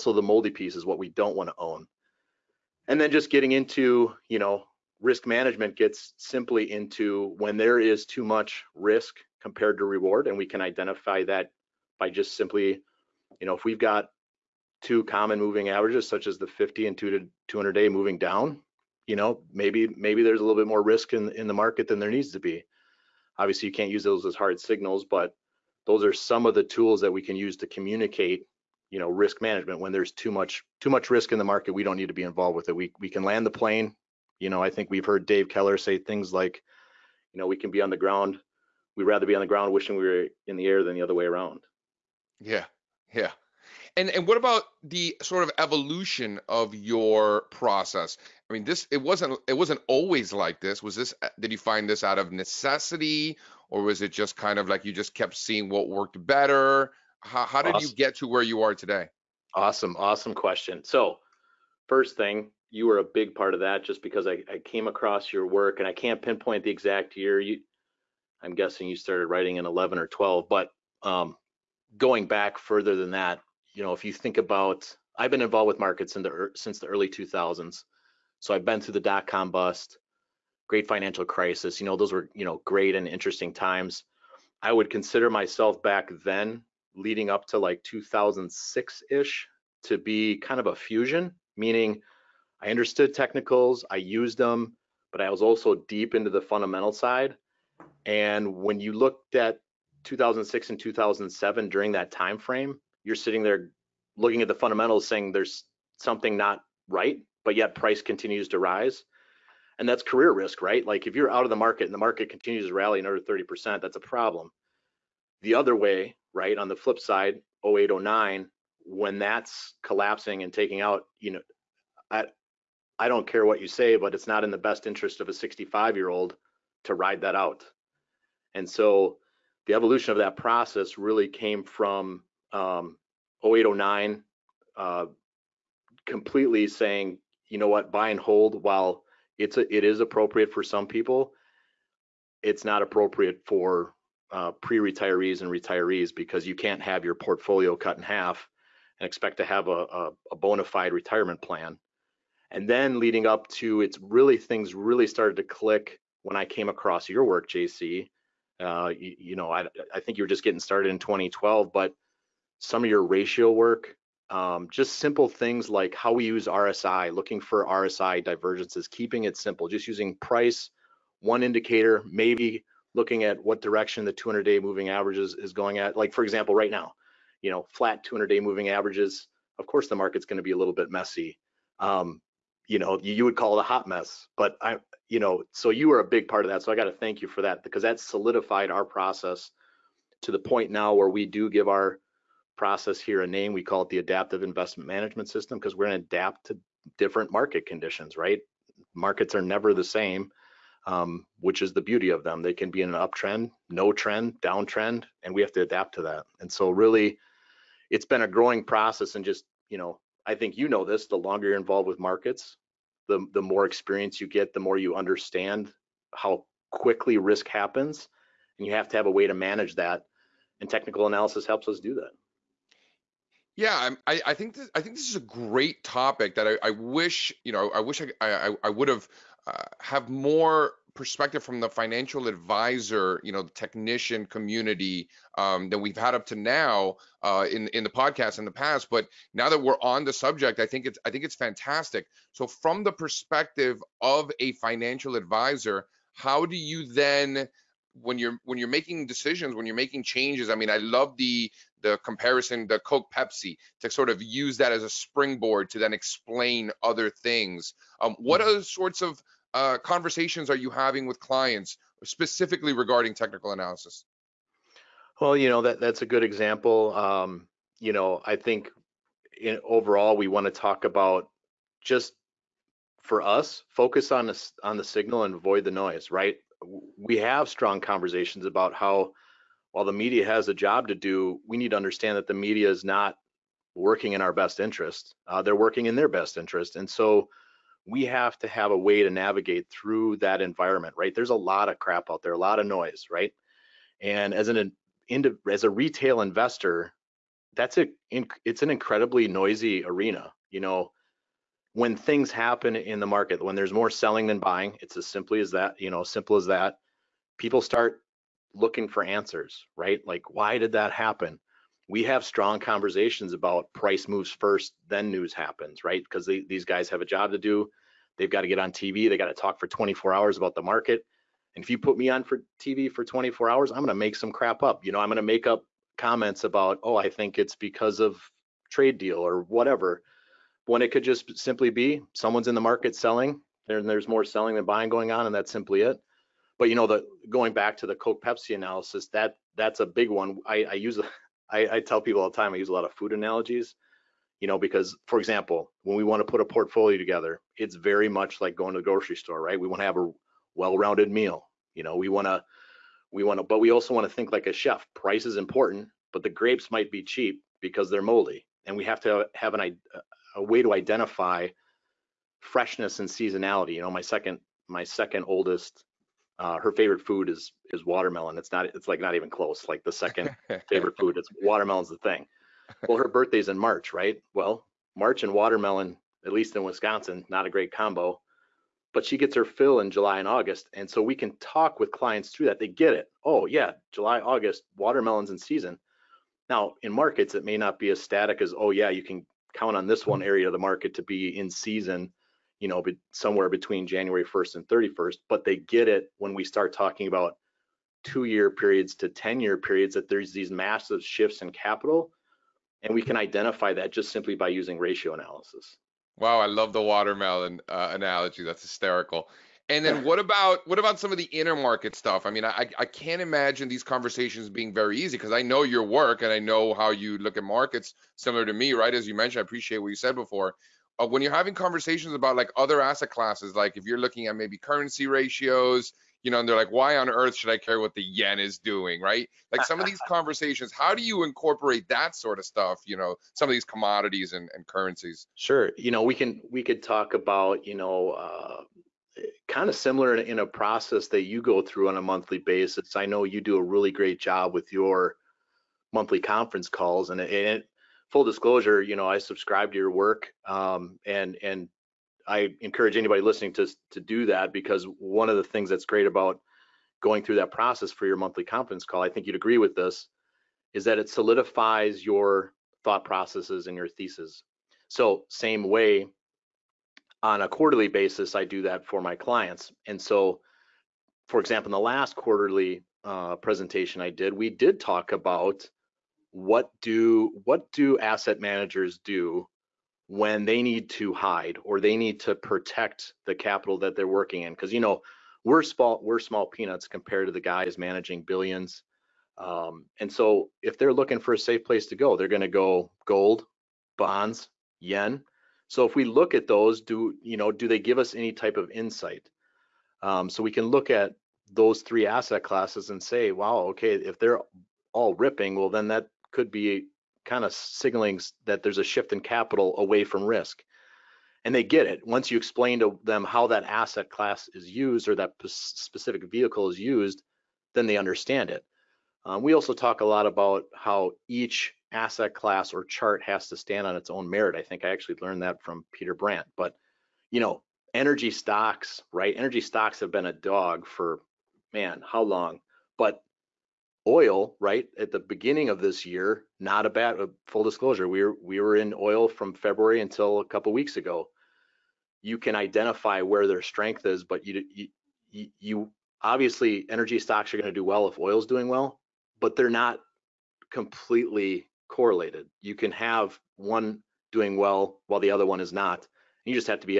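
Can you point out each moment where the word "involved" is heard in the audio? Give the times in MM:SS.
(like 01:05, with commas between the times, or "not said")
00:32, 01:15, 03:31.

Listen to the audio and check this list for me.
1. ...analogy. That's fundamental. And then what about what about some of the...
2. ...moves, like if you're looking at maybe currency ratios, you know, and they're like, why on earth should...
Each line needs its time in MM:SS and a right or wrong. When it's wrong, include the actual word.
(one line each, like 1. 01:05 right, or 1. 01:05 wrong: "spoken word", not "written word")
1. 06:47 wrong: "hysterical", not "fundamental"
2. 07:03 wrong: "classes", not "moves".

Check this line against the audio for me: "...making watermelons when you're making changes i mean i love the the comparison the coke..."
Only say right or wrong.
wrong.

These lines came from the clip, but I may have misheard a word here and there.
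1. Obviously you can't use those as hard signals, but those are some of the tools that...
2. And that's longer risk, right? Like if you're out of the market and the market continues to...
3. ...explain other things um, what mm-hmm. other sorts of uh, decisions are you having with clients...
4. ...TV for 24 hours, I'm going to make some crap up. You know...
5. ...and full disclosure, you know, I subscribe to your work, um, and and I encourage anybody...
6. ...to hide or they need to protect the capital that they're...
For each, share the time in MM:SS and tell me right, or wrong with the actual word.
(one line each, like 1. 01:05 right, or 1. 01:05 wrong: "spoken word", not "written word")
1. 00:23 right
2. 01:49 wrong: "career", not "longer"
3. 04:15 wrong: "conversations", not "decisions"
4. 05:22 right
5. 07:27 right
6. 08:00 right.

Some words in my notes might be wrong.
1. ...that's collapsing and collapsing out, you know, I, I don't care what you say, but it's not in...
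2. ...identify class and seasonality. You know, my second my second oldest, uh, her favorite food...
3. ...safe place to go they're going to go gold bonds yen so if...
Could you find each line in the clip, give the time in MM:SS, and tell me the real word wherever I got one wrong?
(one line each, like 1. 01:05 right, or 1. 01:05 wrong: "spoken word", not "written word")
1. 01:59 wrong: "taking", not "collapsing"
2. 06:00 wrong: "freshness", not "class"
3. 08:11 right.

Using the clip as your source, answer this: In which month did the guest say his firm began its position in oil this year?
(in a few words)
February.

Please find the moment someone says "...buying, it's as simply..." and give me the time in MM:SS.
05:04.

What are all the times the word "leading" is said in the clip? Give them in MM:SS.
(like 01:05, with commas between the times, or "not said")
01:26, 02:32.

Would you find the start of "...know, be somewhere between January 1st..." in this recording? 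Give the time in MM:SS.
06:32.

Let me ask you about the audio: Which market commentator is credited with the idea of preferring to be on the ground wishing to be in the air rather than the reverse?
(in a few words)
Dave Keller.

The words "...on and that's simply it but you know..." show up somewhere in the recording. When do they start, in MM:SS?
05:35.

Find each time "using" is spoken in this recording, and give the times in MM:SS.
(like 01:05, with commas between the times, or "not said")
02:49, 06:44.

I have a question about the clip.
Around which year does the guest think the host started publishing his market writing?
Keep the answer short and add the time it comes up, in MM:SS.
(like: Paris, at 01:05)
2012, at 01:10.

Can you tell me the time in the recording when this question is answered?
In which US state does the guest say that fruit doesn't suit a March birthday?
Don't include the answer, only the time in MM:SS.
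06:16.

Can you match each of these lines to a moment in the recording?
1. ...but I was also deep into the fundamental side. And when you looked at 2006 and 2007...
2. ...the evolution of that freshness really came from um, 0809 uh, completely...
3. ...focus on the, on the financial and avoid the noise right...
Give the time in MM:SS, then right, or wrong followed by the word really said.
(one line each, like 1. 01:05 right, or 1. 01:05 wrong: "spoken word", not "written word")
1. 01:35 right
2. 02:09 wrong: "process", not "freshness"
3. 04:33 wrong: "signal", not "financial".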